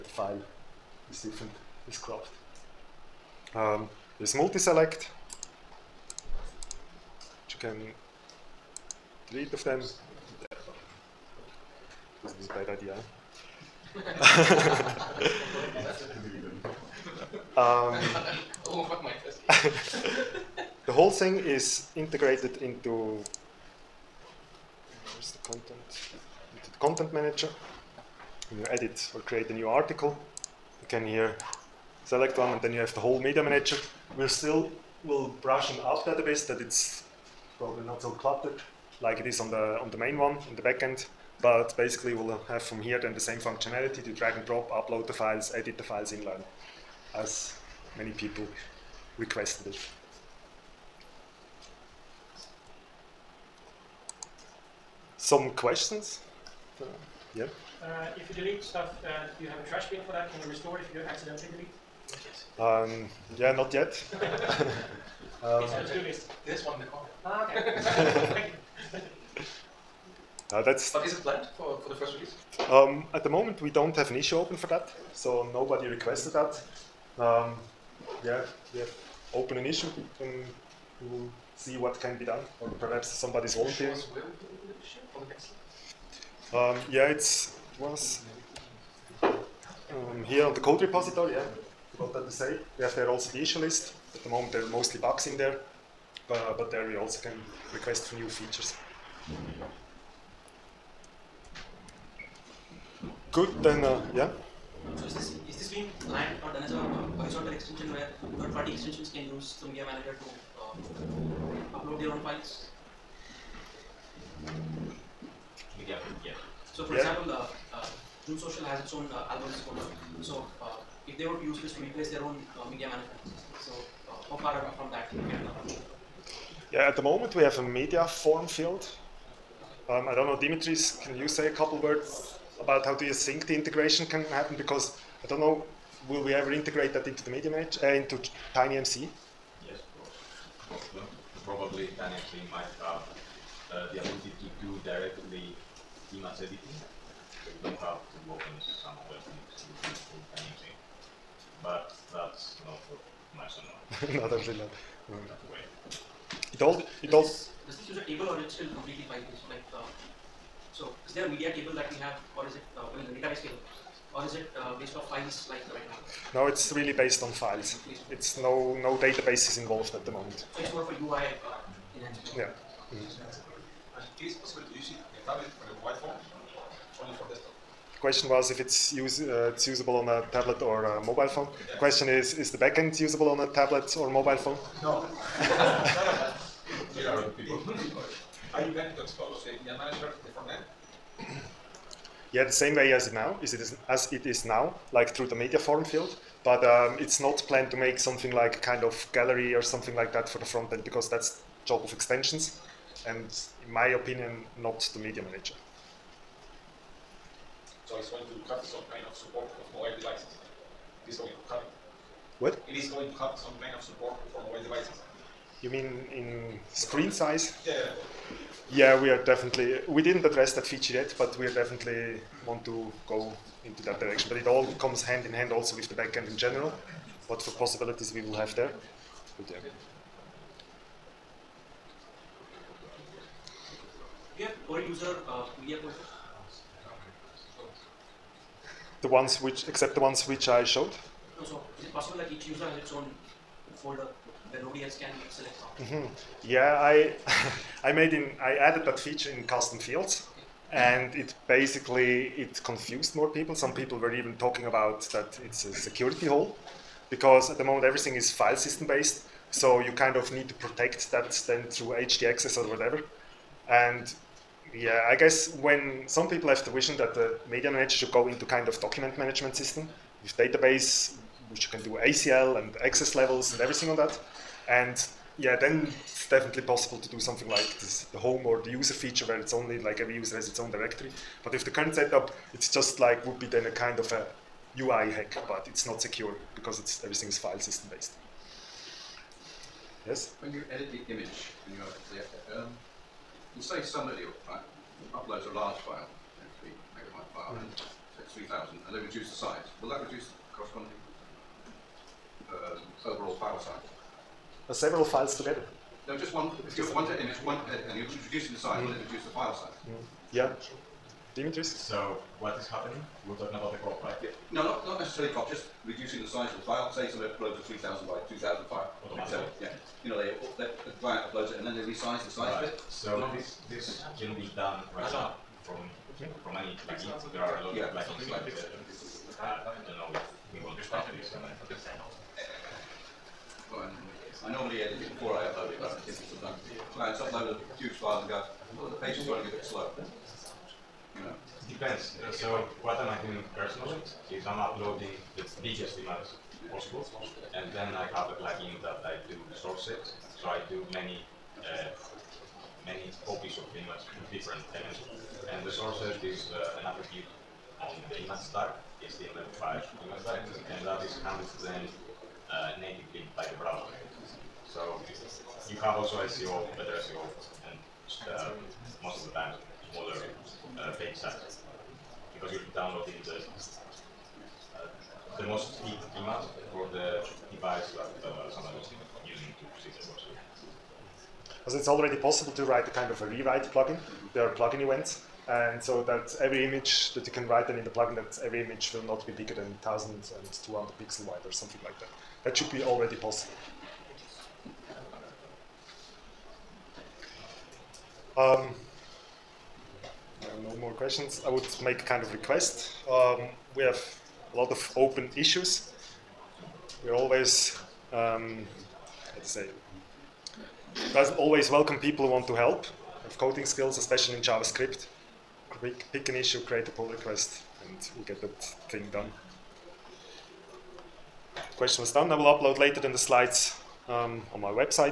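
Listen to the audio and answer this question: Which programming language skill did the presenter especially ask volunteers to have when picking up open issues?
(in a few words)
JavaScript.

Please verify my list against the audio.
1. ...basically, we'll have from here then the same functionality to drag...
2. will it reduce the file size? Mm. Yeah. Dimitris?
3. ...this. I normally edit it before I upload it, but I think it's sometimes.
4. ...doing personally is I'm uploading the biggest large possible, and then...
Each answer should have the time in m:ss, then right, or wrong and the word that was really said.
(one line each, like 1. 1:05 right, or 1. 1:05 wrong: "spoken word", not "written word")
1. 0:41 right
2. 5:08 right
3. 5:31 right
4. 5:43 wrong: "image", not "large".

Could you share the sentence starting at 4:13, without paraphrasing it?
Some people were even talking about that it's a security hole because at the moment everything is file system based.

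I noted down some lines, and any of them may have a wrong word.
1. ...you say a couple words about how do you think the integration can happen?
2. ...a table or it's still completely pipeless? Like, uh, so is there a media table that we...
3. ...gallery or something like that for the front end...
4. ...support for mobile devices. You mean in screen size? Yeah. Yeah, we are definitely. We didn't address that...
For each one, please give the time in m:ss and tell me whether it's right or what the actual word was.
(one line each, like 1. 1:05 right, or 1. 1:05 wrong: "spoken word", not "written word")
1. 2:11 right
2. 2:37 right
3. 3:19 right
4. 3:33 right.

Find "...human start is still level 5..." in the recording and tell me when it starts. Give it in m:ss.
5:58.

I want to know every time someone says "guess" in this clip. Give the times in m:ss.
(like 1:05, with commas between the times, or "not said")
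4:25.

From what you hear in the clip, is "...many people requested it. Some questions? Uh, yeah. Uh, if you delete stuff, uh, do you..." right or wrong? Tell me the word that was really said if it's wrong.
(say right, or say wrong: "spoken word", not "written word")
right.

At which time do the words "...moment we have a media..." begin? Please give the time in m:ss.
2:07.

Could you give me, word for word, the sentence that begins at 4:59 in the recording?
Will that reduce the corresponding uh, overall file size?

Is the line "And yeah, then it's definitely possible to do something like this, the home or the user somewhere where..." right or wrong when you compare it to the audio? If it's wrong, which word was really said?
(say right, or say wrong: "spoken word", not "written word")
wrong: "feature", not "somewhere".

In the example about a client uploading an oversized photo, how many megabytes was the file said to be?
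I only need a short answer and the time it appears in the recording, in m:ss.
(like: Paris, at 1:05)
3, at 4:56.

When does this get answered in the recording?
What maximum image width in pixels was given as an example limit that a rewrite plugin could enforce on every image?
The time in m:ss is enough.
6:29.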